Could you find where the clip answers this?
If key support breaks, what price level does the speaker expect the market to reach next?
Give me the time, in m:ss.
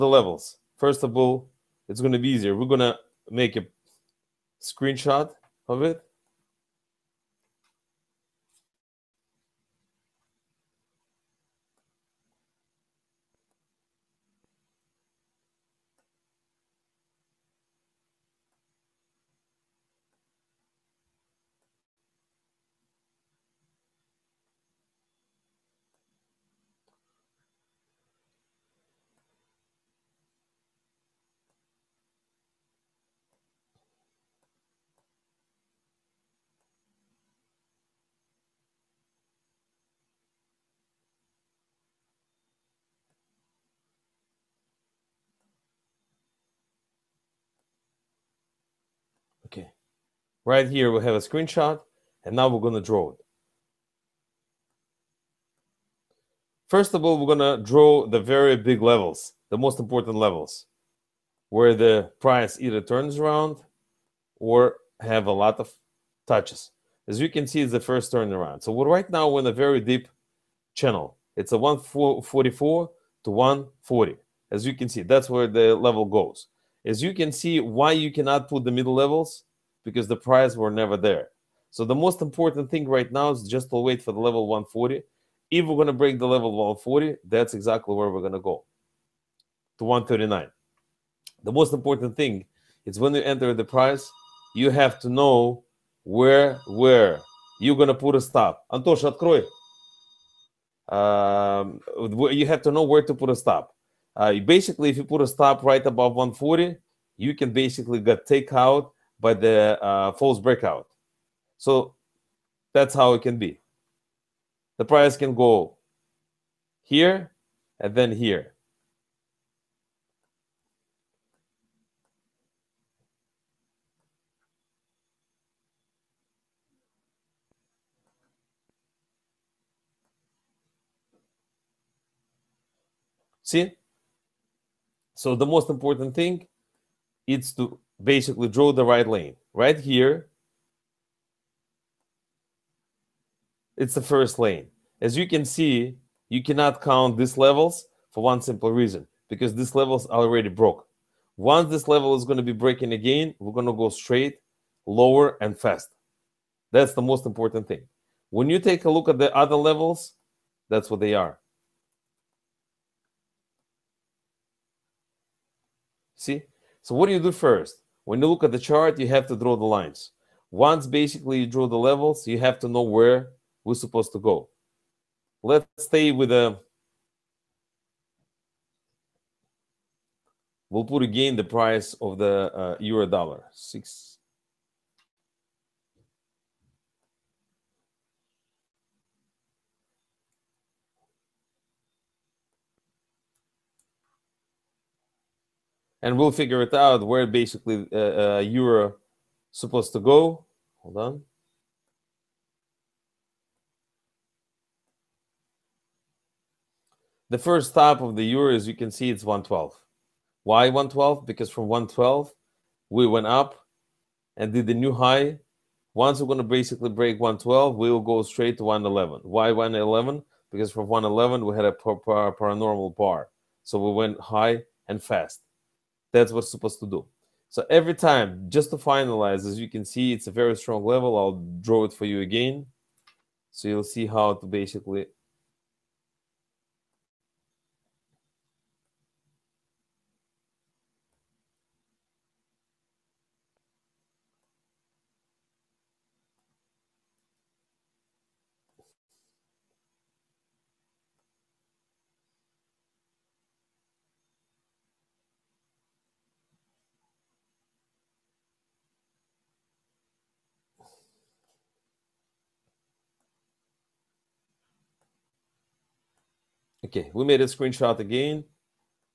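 1:29.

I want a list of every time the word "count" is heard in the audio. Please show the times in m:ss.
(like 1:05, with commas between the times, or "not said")
2:26.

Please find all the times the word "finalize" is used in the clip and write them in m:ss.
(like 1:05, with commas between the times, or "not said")
3:48.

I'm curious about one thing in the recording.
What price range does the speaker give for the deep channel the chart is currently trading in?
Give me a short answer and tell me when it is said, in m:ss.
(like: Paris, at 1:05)
144 to 140, at 1:11.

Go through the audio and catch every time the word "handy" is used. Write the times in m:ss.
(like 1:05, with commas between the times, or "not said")
not said.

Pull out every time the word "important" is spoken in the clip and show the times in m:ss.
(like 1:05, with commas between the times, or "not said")
0:59, 1:22, 1:31, 2:15, 2:37.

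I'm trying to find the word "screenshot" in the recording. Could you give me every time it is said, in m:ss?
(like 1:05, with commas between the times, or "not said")
0:04, 0:51, 4:27.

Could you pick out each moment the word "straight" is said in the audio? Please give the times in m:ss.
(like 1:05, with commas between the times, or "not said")
2:33, 3:38.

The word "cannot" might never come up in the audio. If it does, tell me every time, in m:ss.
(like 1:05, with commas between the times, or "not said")
1:18, 2:26.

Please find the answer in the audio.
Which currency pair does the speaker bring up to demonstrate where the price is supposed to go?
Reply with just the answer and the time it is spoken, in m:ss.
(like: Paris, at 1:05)
Euro dollar, at 3:02.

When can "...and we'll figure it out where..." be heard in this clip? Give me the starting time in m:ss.
3:16.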